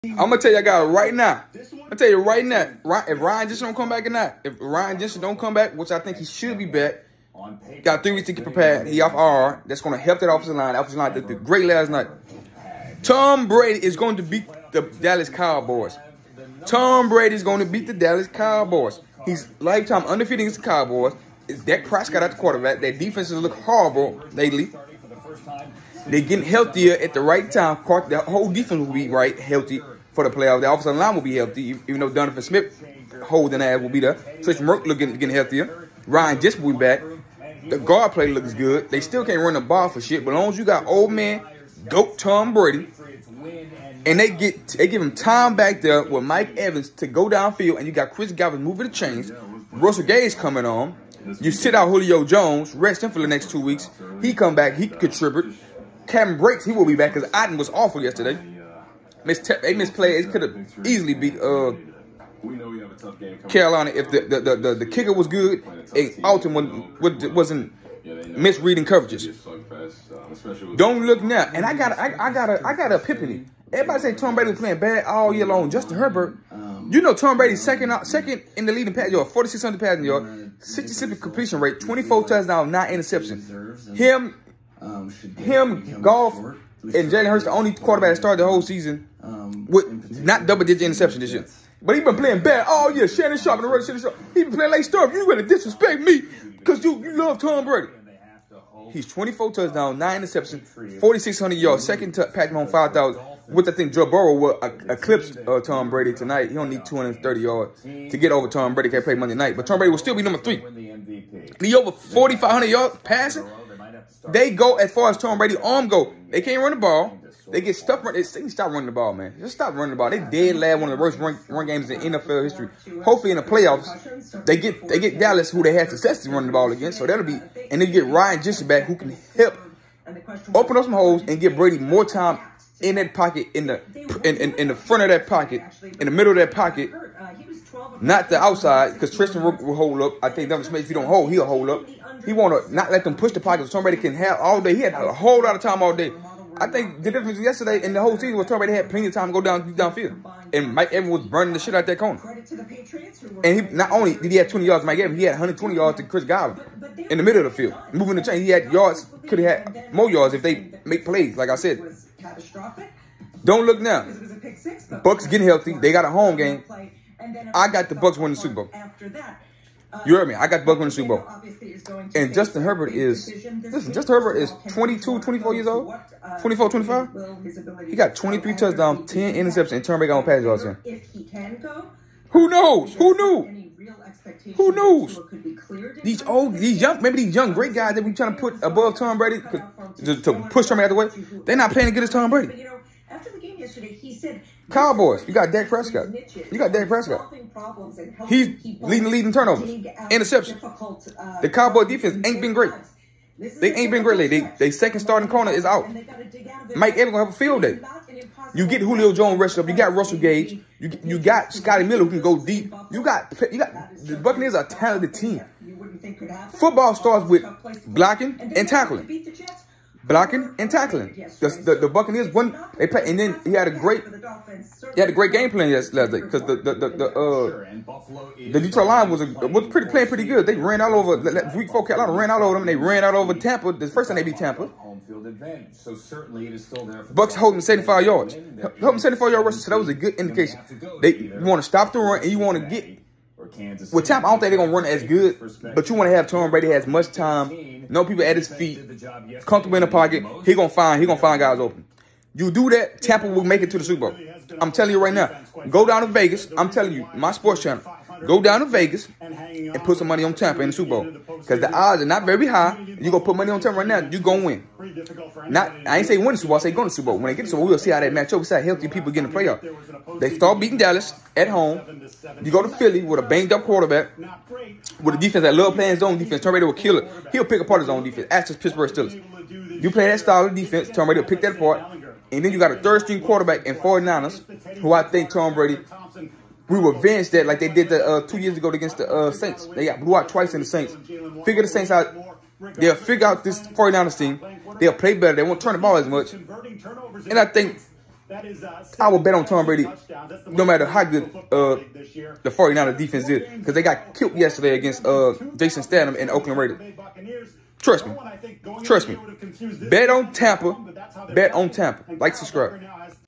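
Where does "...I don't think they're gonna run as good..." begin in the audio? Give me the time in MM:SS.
04:04.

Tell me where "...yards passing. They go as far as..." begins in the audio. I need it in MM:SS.
01:52.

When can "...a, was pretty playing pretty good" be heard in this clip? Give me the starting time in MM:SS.
03:49.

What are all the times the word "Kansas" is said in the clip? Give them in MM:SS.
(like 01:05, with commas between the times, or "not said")
04:03.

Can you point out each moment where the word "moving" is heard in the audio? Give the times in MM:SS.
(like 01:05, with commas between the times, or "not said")
00:48, 02:37.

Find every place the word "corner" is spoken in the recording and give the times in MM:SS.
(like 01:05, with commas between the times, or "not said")
02:31, 03:25.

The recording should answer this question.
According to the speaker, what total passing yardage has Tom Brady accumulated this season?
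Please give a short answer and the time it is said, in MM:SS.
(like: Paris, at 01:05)
4,600, at 01:19.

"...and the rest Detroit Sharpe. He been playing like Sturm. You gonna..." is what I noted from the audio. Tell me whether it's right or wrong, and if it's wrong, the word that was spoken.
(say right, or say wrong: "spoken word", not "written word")
wrong: "Shannon", not "Detroit".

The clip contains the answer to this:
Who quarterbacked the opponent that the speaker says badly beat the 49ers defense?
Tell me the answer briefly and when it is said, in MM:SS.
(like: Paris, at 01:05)
Jarrett Stidham, at 05:05.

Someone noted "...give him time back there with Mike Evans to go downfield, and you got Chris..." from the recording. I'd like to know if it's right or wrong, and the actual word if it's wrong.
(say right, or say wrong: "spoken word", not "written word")
right.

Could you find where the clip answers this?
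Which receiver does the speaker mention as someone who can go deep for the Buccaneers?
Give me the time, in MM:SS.
03:31.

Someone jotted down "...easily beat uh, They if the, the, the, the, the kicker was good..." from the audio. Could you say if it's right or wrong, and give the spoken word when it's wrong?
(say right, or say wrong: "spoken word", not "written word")
wrong: "Carolina", not "They".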